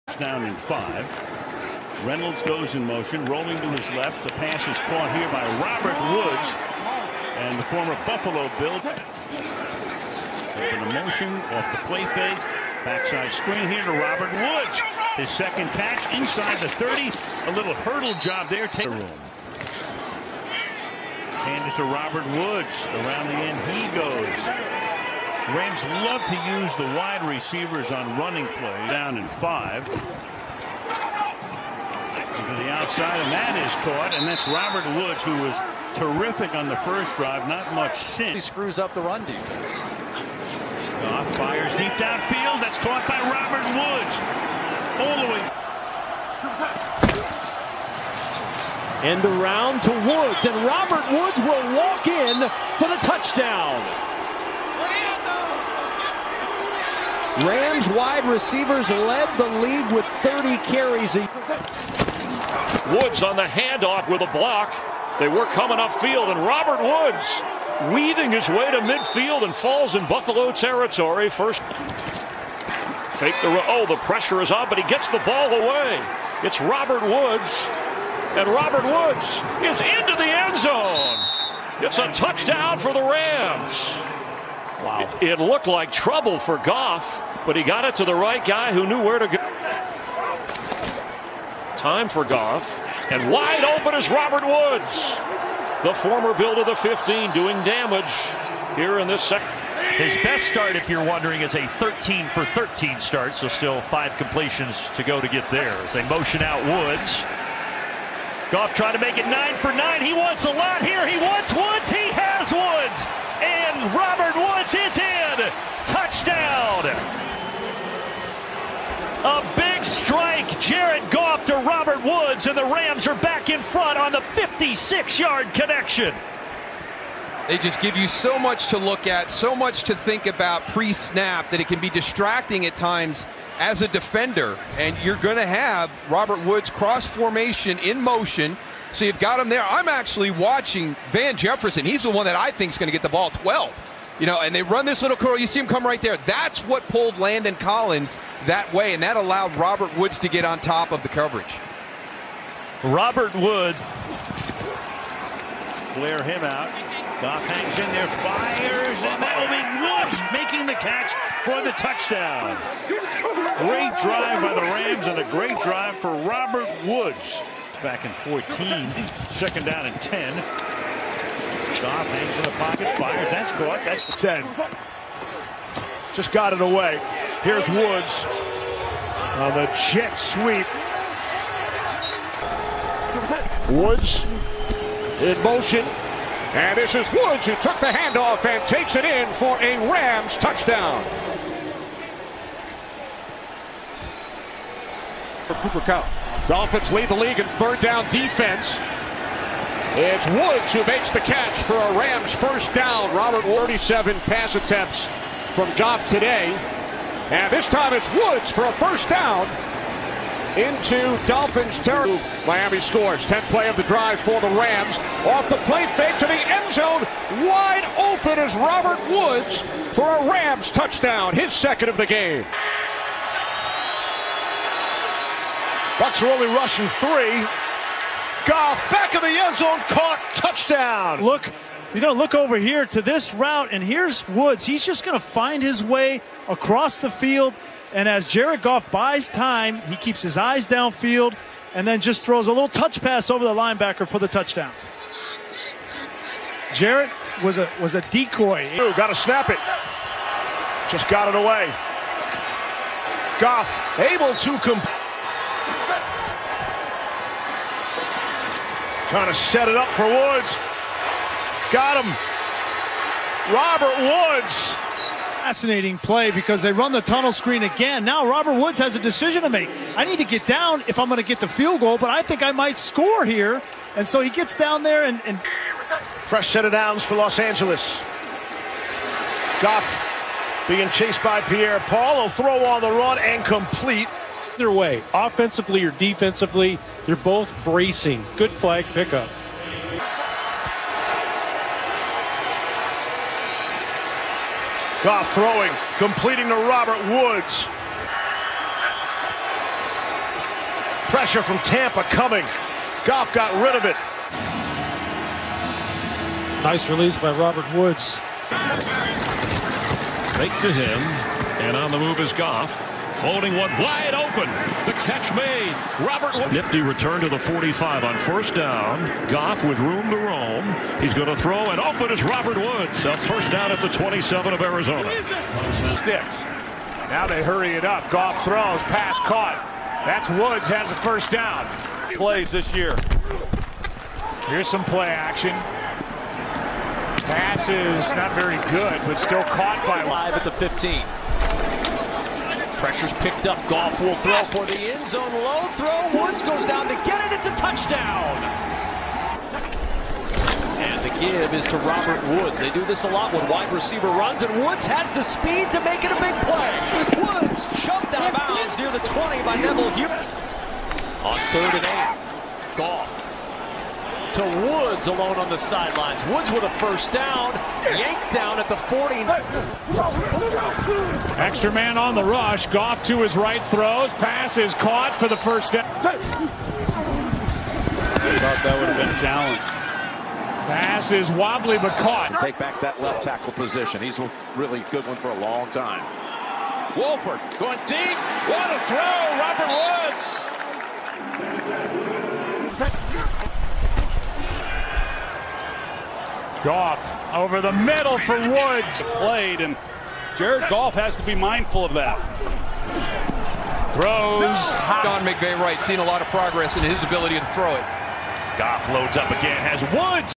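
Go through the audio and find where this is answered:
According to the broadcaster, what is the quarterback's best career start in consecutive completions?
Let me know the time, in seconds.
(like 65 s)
101 s.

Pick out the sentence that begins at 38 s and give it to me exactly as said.
He screws up the run defense.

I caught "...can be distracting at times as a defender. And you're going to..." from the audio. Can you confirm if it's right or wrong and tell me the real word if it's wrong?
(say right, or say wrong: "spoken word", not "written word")
right.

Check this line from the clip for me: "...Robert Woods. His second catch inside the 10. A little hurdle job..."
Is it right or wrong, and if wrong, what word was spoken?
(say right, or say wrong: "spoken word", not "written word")
wrong: "30", not "10".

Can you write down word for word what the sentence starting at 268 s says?
Now Robert Woods has a decision to make.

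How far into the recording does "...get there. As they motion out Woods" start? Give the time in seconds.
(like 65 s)
105 s.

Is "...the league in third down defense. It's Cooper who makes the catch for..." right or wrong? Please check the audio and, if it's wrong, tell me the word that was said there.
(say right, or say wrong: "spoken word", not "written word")
wrong: "Woods", not "Cooper".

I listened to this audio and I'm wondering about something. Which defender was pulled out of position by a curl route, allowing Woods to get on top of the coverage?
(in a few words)
Landon Collins.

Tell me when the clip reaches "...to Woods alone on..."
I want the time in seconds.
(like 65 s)
364 s.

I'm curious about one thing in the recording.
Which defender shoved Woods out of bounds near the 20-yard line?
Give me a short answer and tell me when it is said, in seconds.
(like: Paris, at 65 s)
Neville Hewitt, at 359 s.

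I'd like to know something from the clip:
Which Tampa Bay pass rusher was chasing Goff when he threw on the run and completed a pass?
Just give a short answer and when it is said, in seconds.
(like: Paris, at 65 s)
Pierre Paul, at 281 s.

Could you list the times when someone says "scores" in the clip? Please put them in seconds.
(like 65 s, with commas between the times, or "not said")
212 s, 272 s.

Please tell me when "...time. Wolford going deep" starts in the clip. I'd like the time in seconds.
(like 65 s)
385 s.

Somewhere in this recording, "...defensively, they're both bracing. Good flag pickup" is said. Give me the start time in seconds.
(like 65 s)
285 s.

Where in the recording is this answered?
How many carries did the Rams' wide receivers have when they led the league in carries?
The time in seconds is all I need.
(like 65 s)
60 s.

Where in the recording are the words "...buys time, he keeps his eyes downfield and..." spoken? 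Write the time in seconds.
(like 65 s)
238 s.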